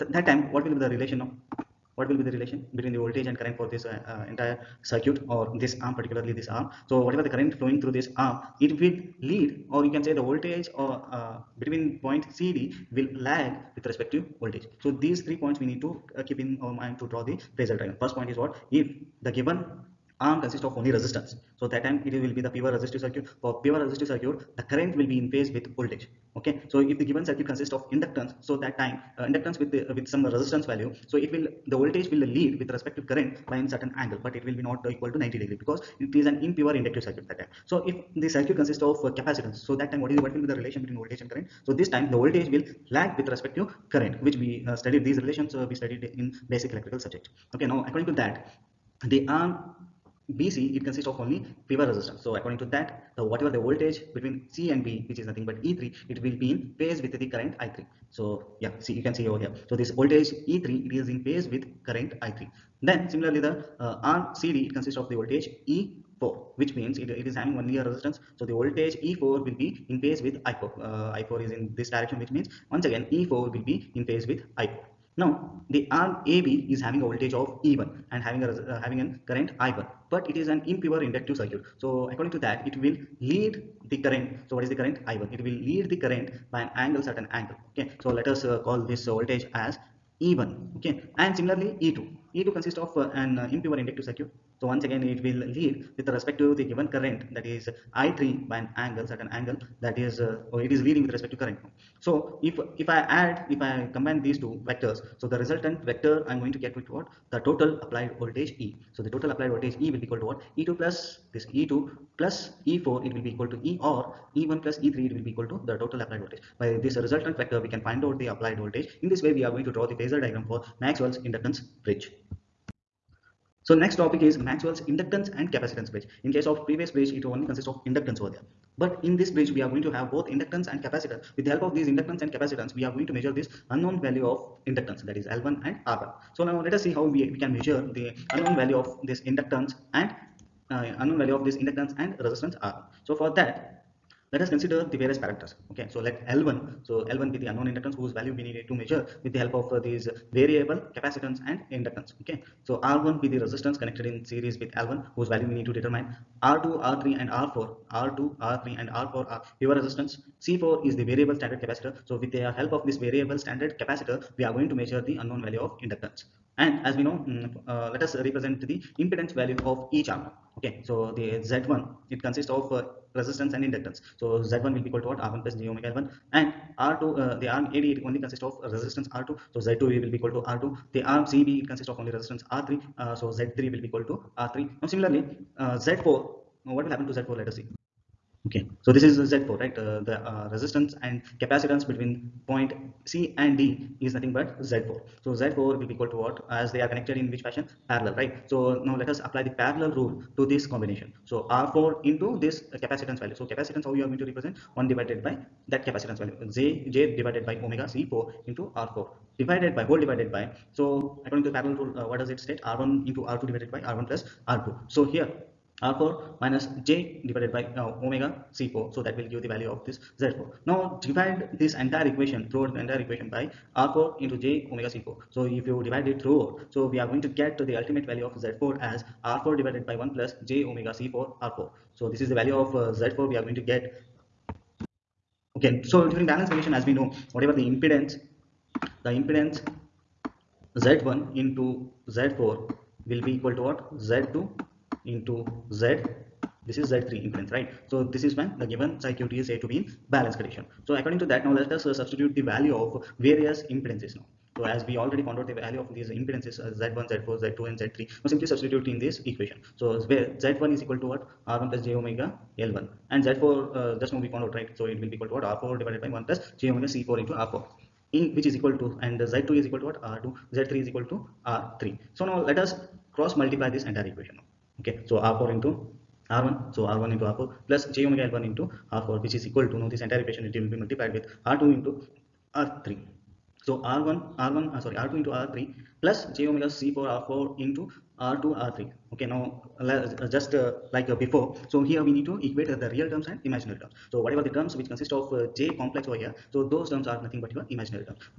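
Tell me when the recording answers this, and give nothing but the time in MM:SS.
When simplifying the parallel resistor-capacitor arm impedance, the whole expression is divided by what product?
03:43.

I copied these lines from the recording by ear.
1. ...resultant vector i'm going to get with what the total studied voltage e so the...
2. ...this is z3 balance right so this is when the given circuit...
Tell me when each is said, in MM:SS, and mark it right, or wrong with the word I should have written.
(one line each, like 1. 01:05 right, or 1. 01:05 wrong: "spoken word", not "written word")
1. 01:45 wrong: "applied", not "studied"
2. 04:06 wrong: "impedance", not "balance".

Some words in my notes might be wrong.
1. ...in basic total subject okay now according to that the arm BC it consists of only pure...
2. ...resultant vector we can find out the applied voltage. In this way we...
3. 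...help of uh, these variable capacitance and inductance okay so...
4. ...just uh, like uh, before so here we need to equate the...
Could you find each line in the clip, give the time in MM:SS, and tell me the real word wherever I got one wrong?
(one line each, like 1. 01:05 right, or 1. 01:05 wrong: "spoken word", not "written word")
1. 00:46 wrong: "electrical", not "total"
2. 01:56 right
3. 02:29 right
4. 04:50 right.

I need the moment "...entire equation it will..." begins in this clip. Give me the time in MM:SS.
04:40.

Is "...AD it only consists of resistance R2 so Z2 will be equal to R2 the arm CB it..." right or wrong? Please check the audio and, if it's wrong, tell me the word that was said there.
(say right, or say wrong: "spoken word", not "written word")
right.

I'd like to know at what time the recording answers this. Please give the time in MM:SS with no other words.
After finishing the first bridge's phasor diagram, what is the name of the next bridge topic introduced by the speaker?
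02:04.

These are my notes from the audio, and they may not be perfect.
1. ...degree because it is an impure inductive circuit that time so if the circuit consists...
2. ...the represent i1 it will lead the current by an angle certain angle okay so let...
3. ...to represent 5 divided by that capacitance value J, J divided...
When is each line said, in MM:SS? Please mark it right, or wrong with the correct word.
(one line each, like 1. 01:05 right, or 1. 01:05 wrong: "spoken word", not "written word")
1. 00:35 right
2. 01:24 wrong: "current", not "represent"
3. 03:24 wrong: "1", not "5".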